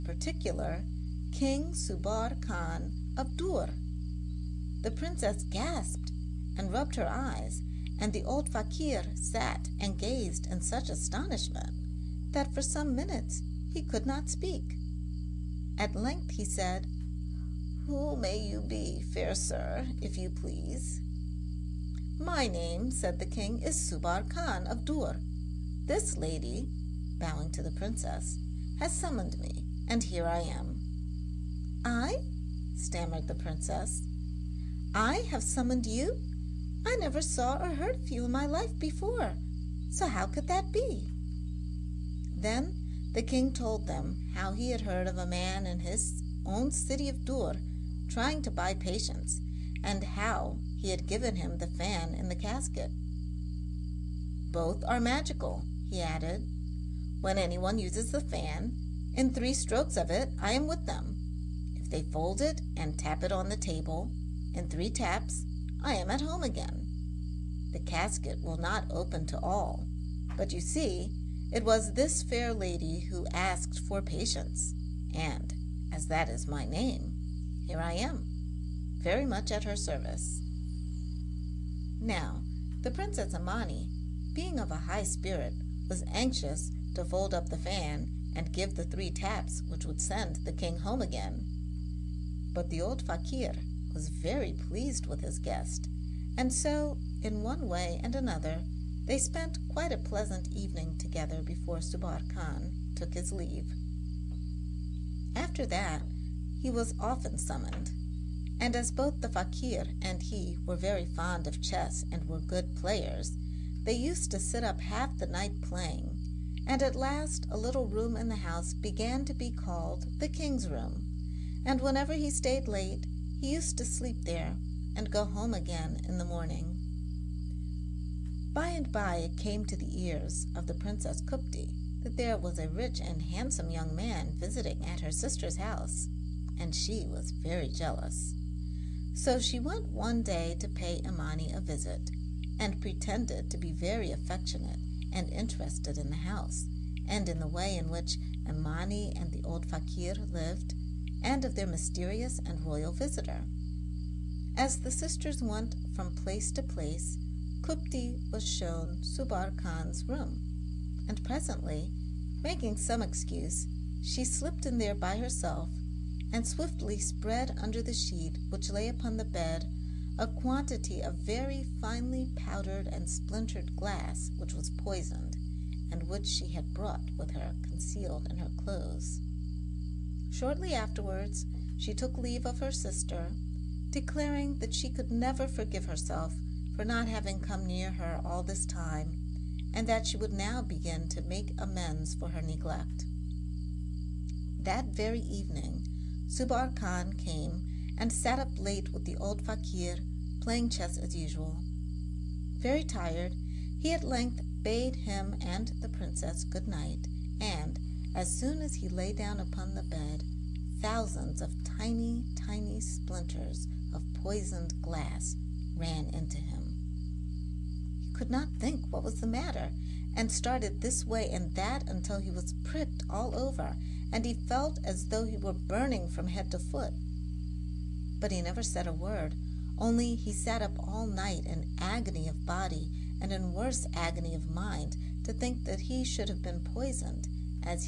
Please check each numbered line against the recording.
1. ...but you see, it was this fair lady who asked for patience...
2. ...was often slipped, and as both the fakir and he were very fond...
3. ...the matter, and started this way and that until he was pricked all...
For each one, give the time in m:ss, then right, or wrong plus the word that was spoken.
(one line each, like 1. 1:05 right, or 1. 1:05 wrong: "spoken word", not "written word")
1. 1:10 right
2. 1:46 wrong: "summoned", not "slipped"
3. 3:39 right.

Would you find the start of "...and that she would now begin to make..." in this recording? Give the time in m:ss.
3:09.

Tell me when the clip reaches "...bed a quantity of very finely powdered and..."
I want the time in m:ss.
2:49.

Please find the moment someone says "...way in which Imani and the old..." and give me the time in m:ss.
2:27.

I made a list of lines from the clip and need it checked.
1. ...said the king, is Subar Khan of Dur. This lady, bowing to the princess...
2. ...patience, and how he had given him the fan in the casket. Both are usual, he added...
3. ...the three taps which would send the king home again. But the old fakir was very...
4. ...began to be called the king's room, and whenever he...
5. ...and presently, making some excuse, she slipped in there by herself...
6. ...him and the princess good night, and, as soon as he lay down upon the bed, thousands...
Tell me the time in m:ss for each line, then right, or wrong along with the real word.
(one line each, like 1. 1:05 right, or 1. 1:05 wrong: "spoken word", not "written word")
1. 0:22 right
2. 0:48 wrong: "magical", not "usual"
3. 1:28 right
4. 1:58 right
5. 2:41 right
6. 3:24 right.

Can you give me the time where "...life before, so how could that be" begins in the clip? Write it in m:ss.
0:38.